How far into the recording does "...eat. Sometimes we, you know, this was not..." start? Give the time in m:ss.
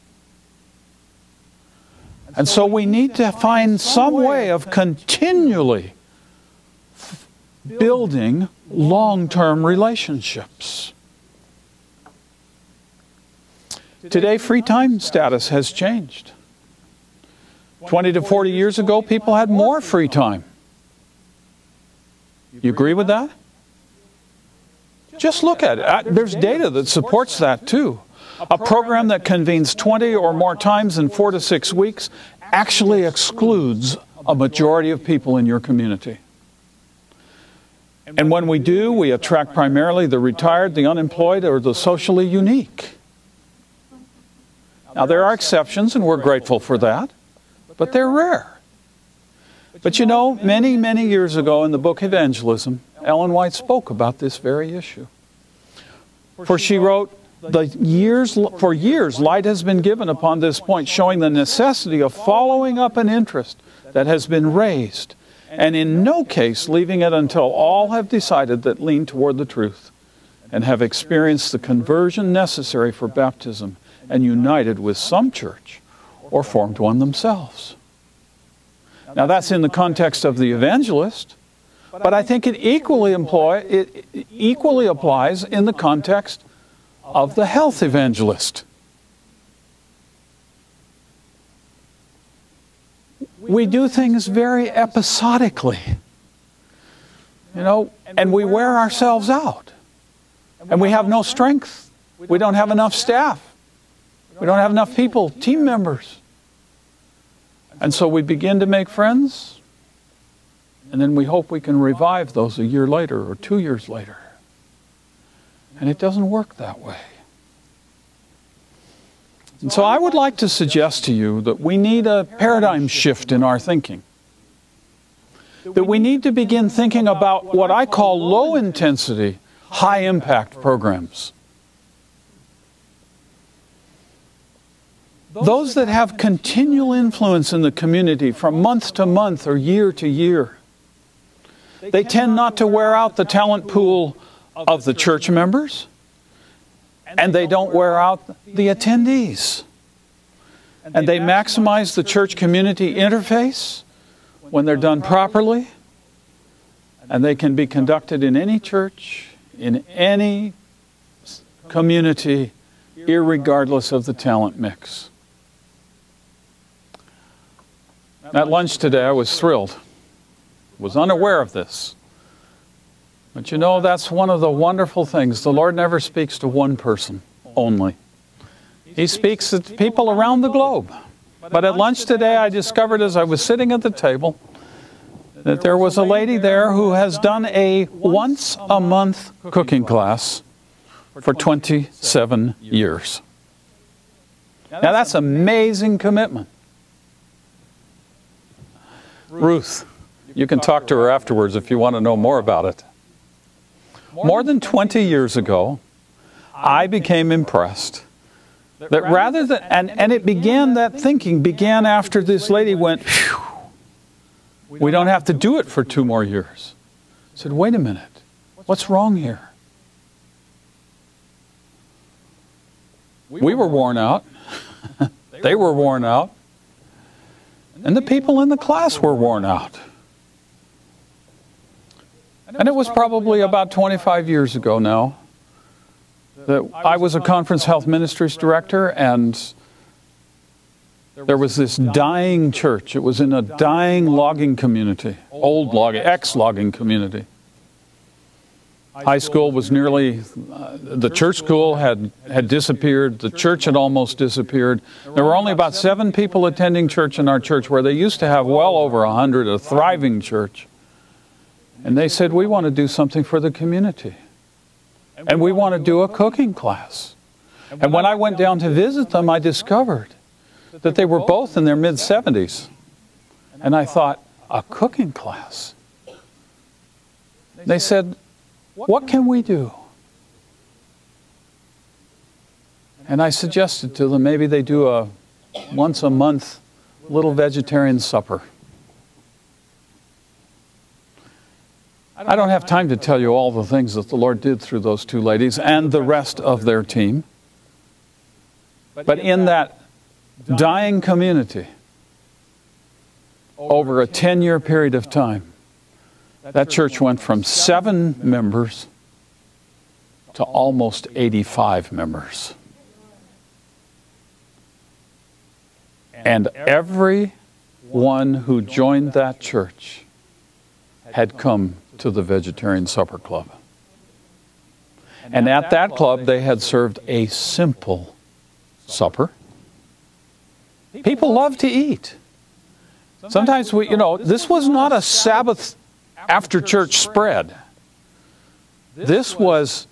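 5:31.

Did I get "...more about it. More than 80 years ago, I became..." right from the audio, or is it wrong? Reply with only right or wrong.
wrong.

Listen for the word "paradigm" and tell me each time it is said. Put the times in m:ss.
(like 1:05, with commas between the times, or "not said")
2:02.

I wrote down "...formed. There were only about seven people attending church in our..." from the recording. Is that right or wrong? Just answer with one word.
wrong.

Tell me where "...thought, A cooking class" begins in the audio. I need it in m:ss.
4:33.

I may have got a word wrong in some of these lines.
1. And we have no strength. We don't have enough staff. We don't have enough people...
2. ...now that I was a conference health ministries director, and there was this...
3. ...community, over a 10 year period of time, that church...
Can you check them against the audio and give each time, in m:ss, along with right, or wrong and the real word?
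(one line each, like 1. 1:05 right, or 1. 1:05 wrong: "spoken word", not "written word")
1. 1:40 right
2. 3:54 right
3. 5:01 right.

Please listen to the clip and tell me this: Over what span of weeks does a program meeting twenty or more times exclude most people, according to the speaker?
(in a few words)
4 to 6 weeks.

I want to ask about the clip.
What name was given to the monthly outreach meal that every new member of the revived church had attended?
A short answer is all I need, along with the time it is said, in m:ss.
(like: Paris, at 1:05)
Vegetarian Supper Club, at 5:22.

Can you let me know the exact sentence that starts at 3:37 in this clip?
I said, wait a minute, what's wrong here?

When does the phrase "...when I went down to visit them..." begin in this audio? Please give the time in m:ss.
4:27.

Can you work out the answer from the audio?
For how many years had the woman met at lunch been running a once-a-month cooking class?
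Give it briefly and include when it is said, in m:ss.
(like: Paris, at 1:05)
27, at 3:11.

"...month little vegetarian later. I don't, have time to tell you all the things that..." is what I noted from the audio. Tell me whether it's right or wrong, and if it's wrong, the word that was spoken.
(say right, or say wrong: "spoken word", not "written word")
wrong: "supper", not "later".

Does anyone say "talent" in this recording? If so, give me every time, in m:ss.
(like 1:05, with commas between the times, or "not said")
2:23, 2:44.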